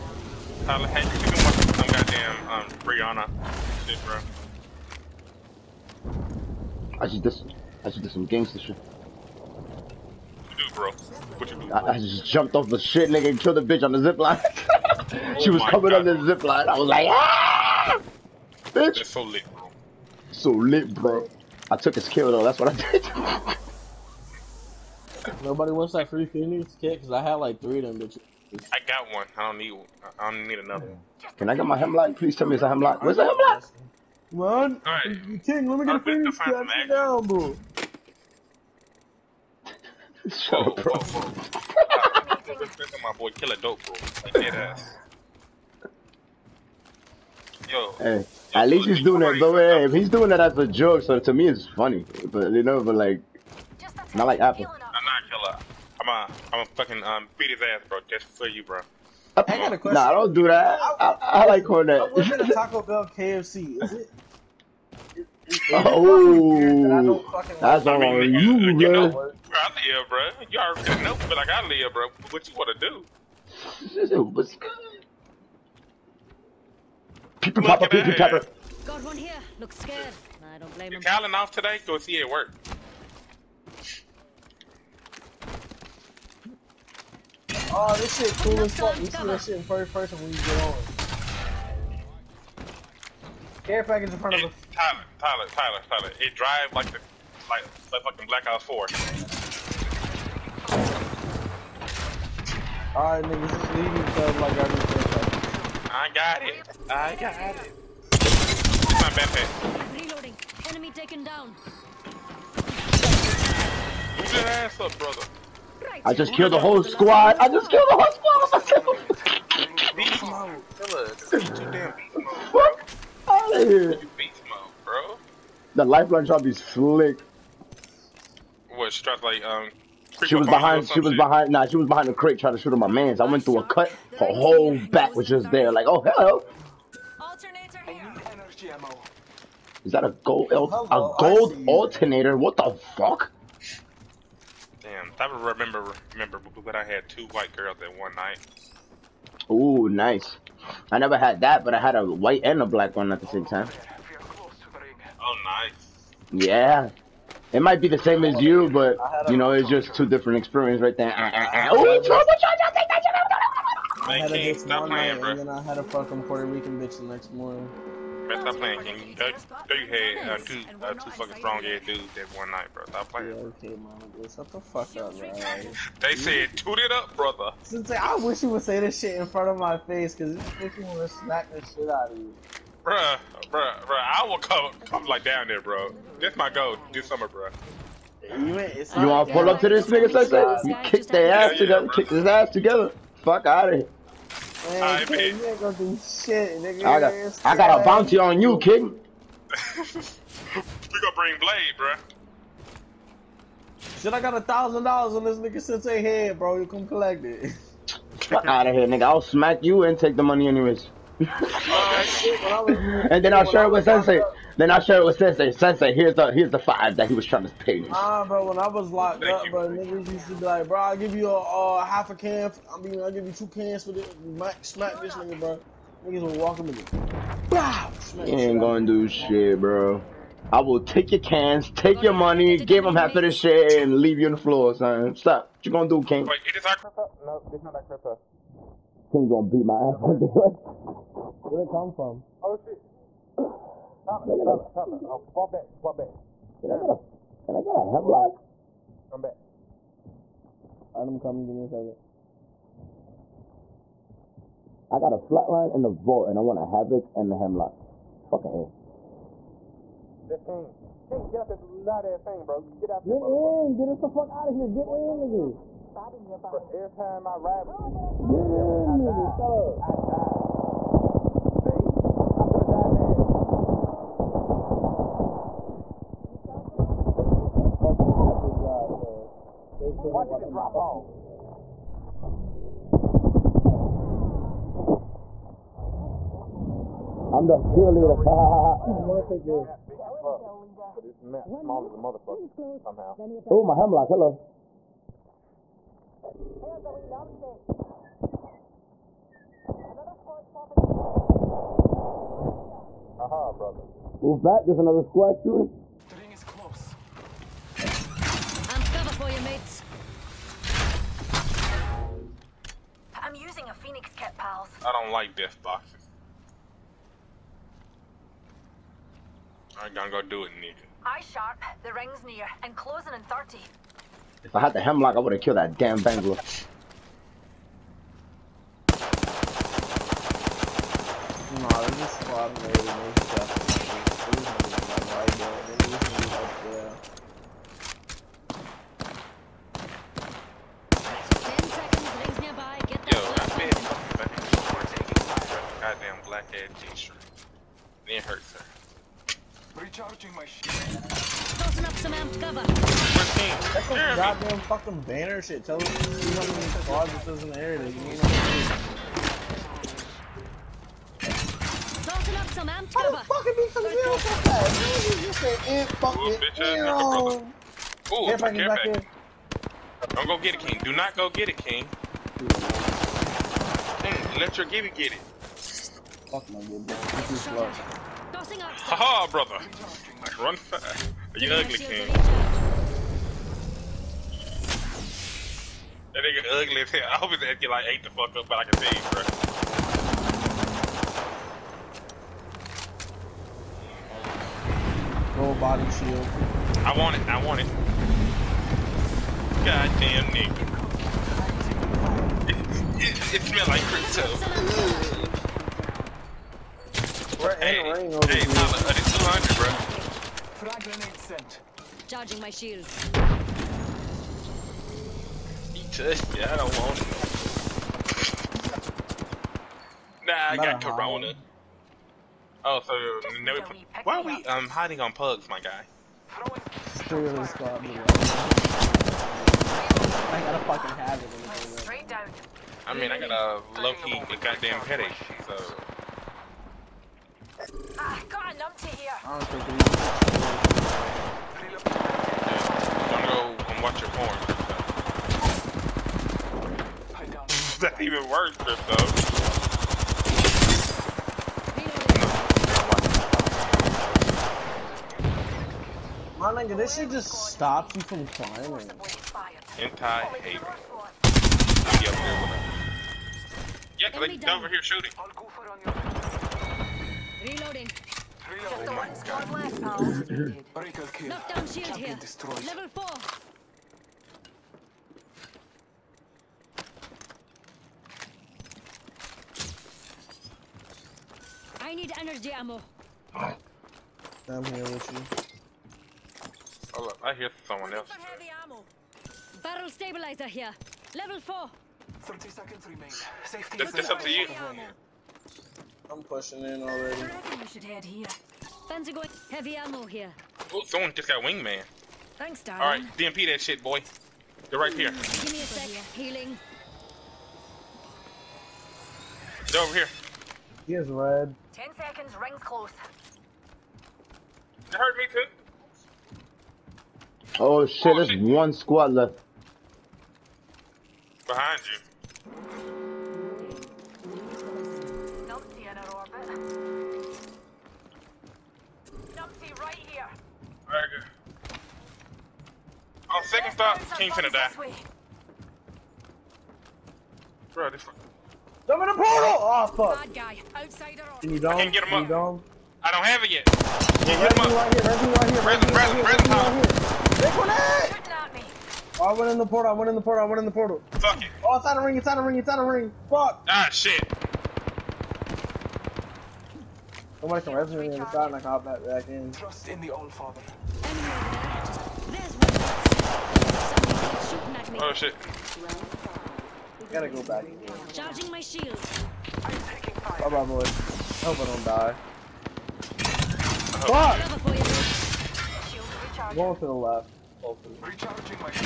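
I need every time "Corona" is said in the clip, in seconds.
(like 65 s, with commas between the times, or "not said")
420 s.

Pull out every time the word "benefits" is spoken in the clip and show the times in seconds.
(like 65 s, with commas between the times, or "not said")
not said.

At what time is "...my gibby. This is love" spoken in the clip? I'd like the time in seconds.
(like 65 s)
376 s.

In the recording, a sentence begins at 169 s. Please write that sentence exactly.
That, you had two, uh, two fucking strong ass dudes that one night, bro.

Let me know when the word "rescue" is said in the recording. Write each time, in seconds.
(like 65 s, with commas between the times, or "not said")
557 s.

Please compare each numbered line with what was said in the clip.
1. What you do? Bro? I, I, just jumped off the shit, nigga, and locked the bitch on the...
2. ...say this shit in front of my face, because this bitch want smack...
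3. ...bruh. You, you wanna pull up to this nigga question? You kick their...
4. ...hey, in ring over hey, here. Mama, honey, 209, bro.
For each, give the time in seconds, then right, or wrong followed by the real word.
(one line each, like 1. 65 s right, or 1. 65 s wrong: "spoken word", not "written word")
1. 10 s wrong: "killed", not "locked"
2. 178 s right
3. 187 s wrong: "section", not "question"
4. 407 s wrong: "200", not "209".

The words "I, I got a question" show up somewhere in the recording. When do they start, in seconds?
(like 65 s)
59 s.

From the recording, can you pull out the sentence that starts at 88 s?
You see that shit in first person when you get on.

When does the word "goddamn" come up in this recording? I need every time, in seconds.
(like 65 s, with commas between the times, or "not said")
1 s, 354 s, 399 s, 434 s.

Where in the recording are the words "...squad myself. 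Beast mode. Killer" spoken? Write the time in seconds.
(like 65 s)
118 s.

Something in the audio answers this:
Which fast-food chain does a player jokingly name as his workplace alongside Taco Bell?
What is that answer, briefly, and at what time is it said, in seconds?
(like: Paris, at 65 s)
KFC, at 63 s.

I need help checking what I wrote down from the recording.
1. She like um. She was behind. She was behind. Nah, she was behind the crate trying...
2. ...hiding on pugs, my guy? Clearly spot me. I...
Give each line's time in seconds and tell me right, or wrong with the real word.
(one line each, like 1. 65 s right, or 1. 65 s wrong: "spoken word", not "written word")
1. 128 s right
2. 424 s right.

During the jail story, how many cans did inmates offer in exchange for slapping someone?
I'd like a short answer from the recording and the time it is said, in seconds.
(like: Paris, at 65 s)
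2, at 223 s.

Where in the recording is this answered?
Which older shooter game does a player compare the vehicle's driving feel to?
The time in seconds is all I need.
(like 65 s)
98 s.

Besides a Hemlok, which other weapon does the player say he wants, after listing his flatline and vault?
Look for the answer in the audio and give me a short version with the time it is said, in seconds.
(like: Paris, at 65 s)
Havoc, at 256 s.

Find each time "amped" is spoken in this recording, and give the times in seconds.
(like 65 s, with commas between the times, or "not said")
352 s, 362 s.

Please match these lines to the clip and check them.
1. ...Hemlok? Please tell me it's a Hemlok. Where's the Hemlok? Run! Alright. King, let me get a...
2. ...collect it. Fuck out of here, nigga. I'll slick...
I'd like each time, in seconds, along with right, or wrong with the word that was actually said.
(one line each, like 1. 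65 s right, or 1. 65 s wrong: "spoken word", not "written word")
1. 31 s right
2. 206 s wrong: "smack", not "slick".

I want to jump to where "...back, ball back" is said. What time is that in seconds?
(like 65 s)
245 s.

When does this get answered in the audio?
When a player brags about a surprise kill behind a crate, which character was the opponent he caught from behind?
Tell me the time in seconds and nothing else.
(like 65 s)
125 s.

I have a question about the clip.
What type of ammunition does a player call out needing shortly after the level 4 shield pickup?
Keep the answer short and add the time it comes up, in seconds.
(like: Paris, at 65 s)
Energy ammo, at 482 s.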